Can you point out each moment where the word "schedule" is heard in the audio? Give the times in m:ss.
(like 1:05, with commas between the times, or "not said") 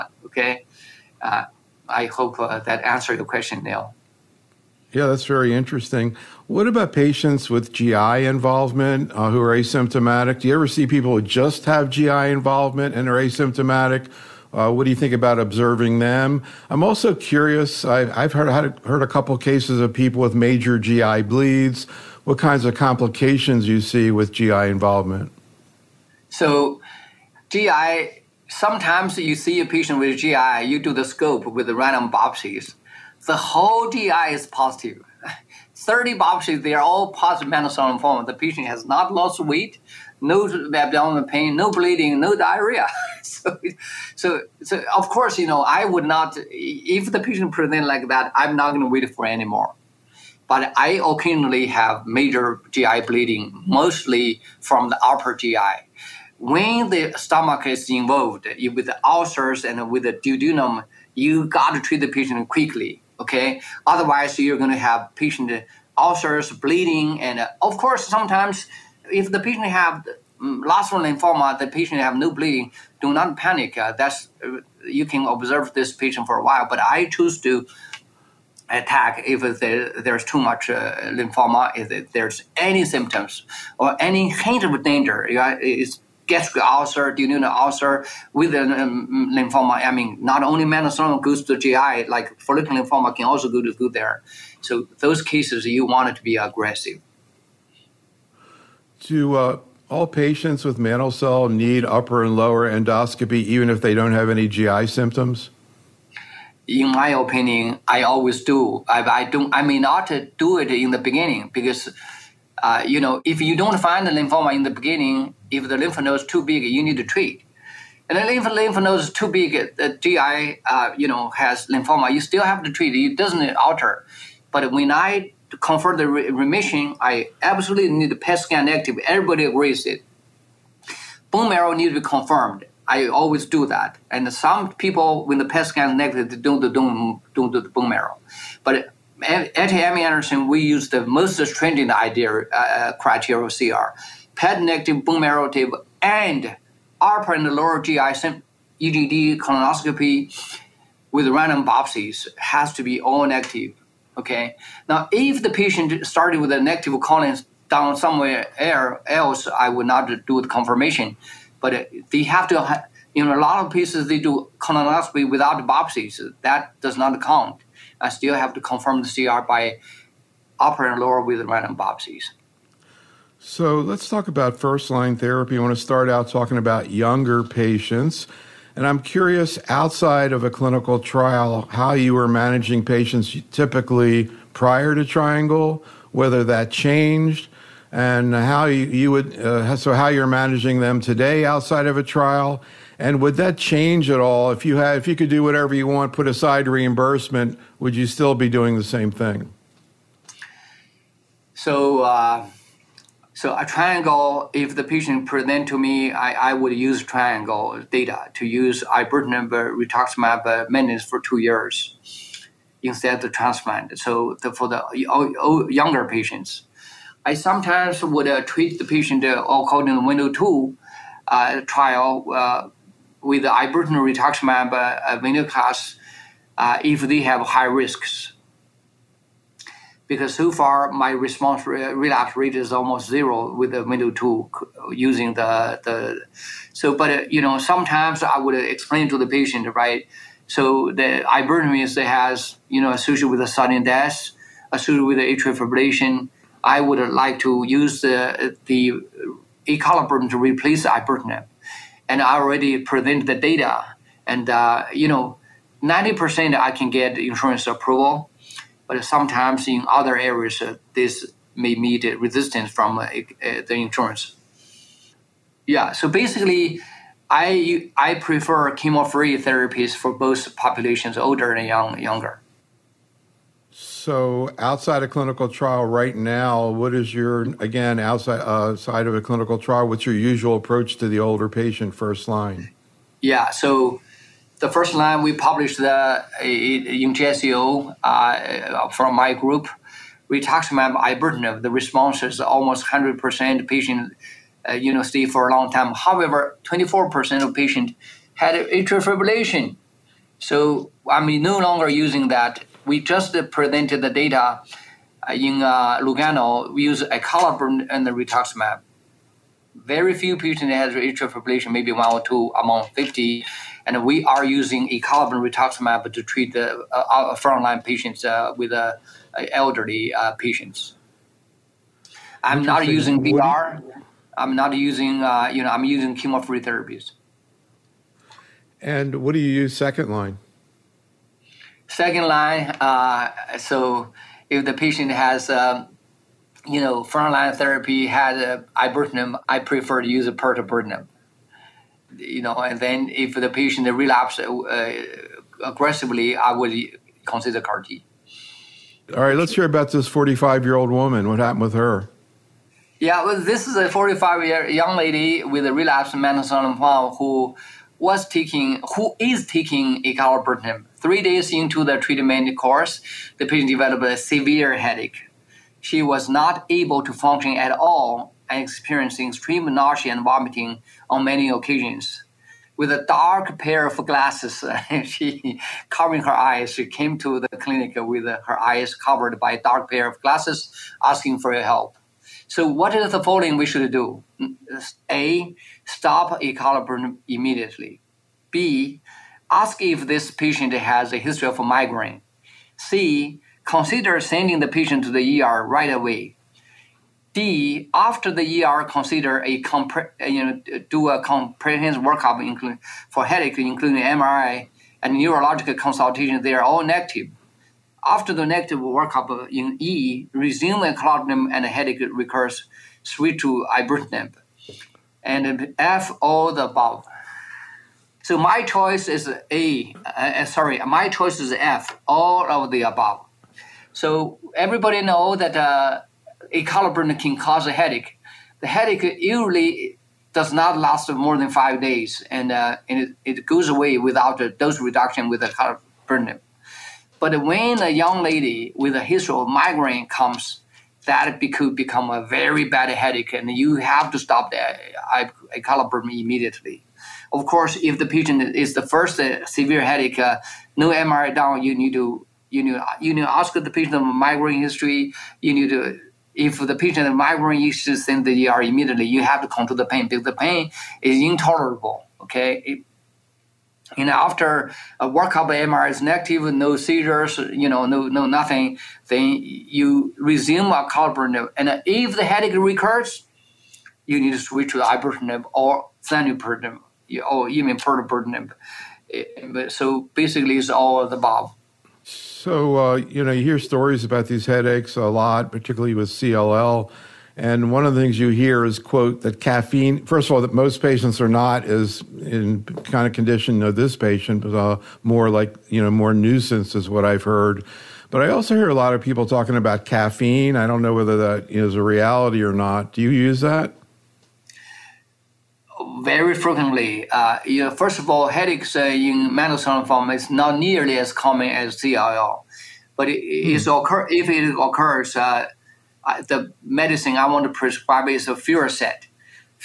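not said.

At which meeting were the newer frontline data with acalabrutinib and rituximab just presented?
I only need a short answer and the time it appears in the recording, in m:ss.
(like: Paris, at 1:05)
Lugano, at 5:06.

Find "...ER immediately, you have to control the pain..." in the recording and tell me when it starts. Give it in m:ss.
7:38.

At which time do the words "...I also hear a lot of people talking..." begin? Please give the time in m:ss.
8:18.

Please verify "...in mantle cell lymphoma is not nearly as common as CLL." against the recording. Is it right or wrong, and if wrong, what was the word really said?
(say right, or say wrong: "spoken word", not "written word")
right.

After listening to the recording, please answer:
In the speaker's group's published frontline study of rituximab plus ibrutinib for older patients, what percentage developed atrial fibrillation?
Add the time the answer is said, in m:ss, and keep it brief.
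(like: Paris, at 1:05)
24%, at 4:56.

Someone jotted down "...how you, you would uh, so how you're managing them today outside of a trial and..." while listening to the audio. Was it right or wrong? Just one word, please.
right.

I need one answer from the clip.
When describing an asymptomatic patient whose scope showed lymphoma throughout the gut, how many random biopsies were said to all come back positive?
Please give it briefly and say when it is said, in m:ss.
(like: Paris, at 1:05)
30, at 0:35.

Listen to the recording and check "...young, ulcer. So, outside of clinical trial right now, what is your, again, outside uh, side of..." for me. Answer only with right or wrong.
wrong.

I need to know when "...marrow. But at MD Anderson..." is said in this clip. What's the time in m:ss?
2:17.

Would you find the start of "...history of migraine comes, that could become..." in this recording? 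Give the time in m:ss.
7:19.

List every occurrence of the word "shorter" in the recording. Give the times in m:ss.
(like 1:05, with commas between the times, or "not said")
not said.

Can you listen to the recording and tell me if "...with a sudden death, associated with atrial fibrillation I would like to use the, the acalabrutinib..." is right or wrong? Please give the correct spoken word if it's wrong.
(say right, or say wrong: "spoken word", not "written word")
right.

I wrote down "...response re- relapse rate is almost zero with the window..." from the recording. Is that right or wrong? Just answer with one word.
right.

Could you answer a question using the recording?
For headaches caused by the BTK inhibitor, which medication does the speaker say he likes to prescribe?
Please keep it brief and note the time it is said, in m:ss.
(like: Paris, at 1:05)
Fioricet, at 8:38.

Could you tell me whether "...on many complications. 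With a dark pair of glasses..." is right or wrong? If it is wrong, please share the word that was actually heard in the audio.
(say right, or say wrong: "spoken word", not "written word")
wrong: "occasions", not "complications".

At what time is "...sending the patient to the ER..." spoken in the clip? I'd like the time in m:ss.
6:34.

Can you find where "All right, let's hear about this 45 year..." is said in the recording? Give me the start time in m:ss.
5:49.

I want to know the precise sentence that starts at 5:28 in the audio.
And what do you use second line?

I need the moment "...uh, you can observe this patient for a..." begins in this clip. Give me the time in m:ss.
1:14.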